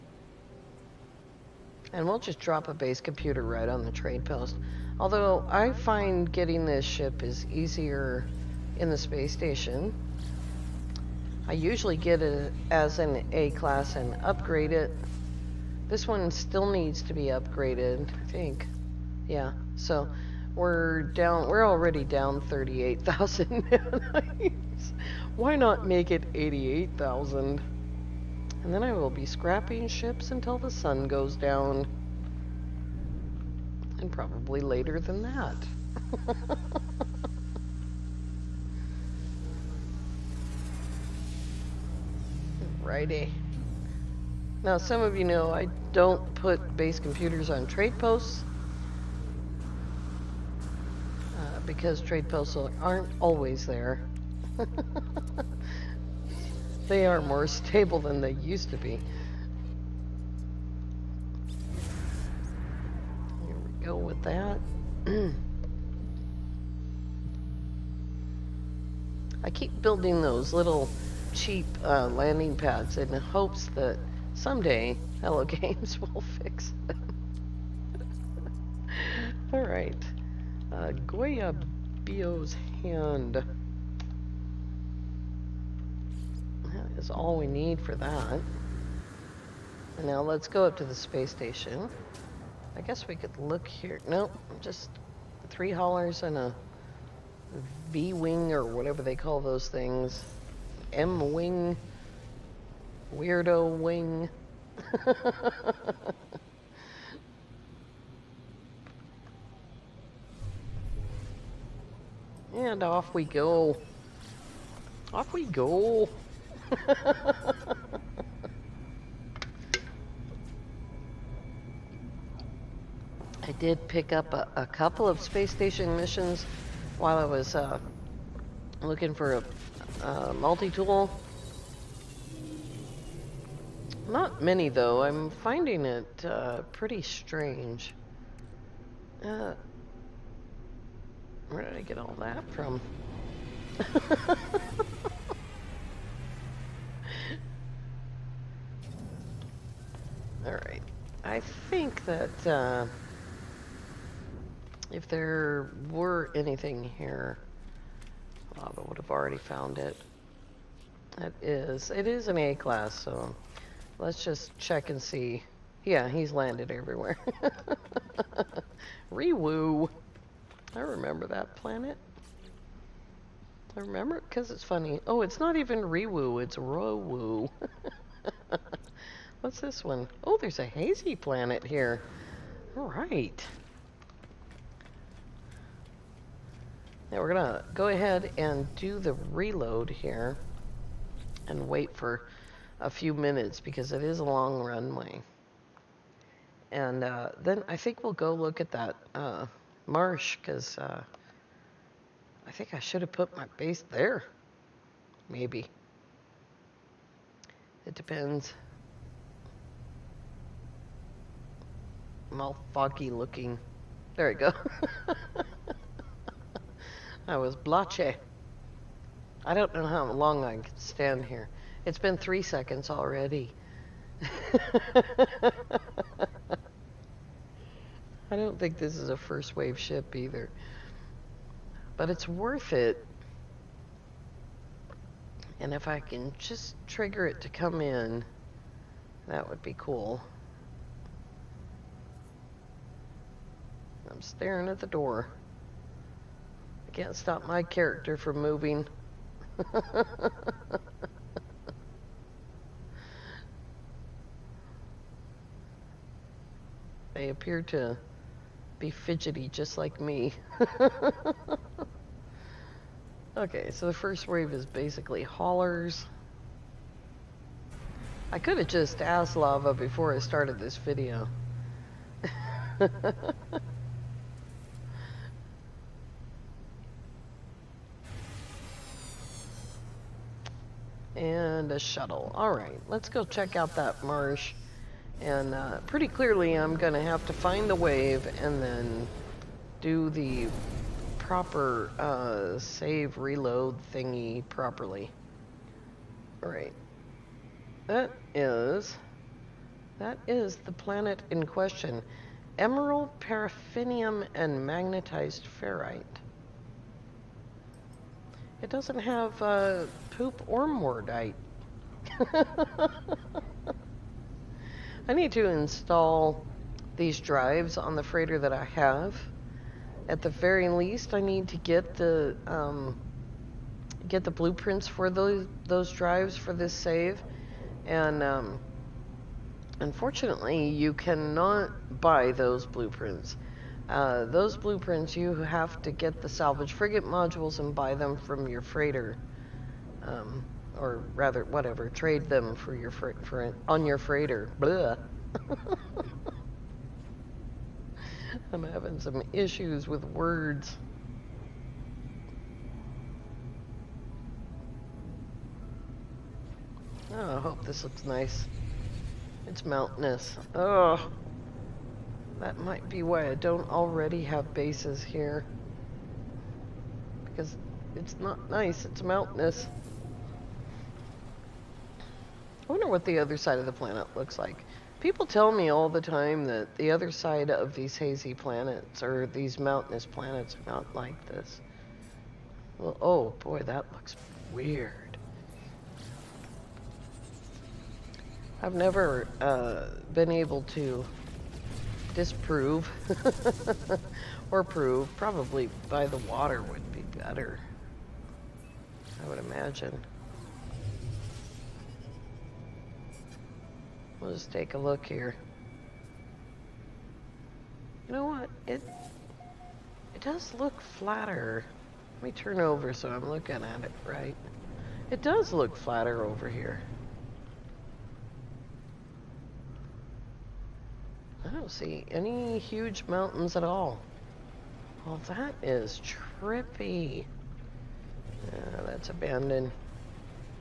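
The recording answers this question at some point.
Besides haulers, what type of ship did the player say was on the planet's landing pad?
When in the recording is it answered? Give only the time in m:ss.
1:40.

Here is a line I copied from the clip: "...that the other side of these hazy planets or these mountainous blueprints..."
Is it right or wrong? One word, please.
wrong.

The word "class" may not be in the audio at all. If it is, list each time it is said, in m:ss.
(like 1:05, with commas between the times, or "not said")
0:13, 2:42.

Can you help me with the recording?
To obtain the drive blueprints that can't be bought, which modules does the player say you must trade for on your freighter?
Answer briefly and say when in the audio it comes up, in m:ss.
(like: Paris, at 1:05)
salvage frigate modules, at 5:36.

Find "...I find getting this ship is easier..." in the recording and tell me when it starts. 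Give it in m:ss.
0:05.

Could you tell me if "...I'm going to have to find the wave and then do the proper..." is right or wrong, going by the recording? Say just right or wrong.
right.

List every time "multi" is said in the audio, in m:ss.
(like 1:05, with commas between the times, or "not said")
2:10.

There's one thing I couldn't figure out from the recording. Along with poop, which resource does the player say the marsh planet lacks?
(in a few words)
mordite.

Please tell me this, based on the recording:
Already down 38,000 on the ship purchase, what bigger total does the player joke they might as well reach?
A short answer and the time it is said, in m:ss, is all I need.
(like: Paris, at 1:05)
88,000, at 0:26.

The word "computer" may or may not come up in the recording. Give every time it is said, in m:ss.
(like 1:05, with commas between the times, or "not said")
0:02, 0:46.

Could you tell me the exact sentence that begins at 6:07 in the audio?
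Because it's not nice, it's mountainous.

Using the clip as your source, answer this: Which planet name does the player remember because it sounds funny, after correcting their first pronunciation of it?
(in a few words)
Rowoo.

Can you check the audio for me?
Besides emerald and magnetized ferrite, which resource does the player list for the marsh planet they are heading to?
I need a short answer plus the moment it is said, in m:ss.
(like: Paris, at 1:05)
paraffinium, at 5:03.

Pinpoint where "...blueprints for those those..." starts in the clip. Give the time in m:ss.
5:24.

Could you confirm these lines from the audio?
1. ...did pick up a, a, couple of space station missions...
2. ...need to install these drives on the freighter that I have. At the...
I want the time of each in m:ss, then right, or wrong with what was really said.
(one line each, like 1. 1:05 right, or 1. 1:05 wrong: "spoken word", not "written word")
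1. 2:03 right
2. 5:15 right.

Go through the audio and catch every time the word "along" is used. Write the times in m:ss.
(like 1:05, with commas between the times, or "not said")
not said.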